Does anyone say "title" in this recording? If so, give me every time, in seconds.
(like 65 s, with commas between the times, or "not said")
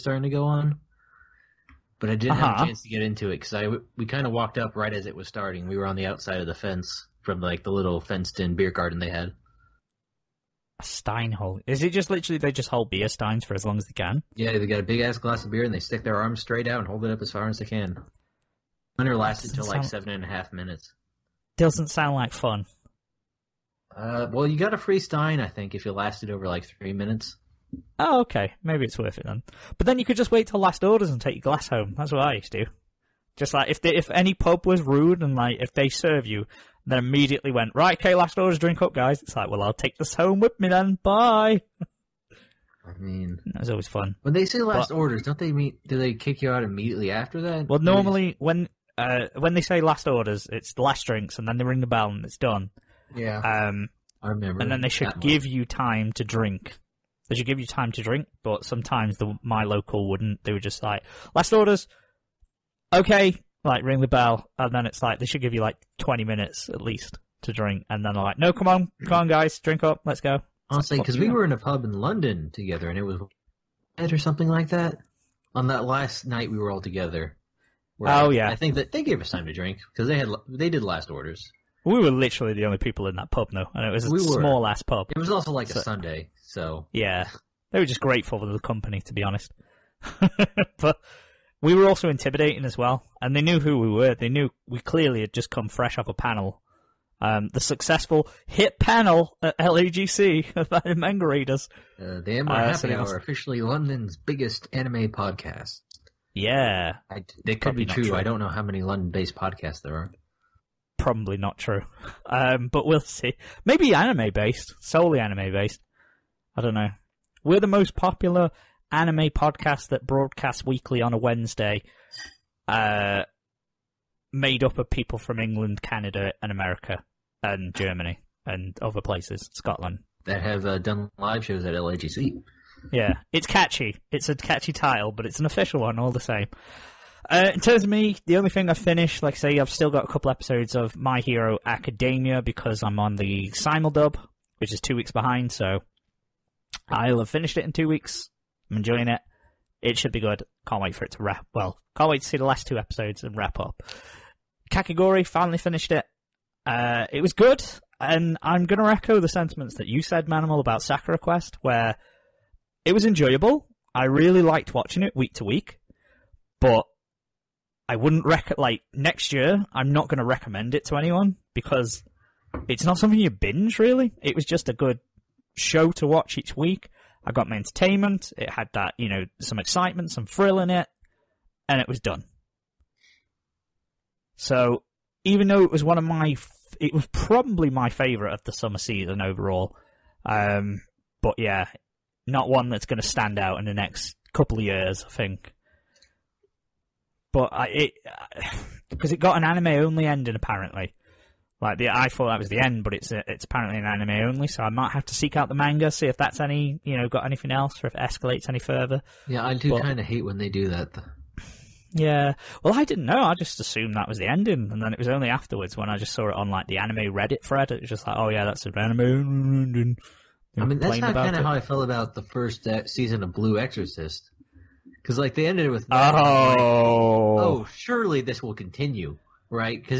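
134 s.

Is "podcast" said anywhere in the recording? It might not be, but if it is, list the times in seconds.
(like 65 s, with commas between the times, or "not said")
105 s, 109 s, 119 s.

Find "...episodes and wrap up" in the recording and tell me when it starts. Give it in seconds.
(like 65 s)
152 s.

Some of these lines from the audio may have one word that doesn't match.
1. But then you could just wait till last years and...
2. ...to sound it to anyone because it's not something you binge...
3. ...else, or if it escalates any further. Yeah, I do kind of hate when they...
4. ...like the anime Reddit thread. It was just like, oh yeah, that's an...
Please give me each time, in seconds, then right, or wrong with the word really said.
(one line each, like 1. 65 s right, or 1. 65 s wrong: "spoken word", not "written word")
1. 29 s wrong: "orders", not "years"
2. 170 s wrong: "recommend", not "sound"
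3. 207 s right
4. 216 s right.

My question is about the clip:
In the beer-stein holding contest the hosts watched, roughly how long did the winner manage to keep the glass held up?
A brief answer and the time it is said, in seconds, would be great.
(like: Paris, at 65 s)
7 and a half minutes, at 19 s.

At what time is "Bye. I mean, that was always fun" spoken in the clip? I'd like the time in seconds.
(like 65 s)
41 s.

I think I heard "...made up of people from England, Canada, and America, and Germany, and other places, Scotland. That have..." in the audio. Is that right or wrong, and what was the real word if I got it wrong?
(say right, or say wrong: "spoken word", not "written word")
right.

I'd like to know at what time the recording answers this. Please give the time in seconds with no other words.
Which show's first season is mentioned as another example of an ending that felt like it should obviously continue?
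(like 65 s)
223 s.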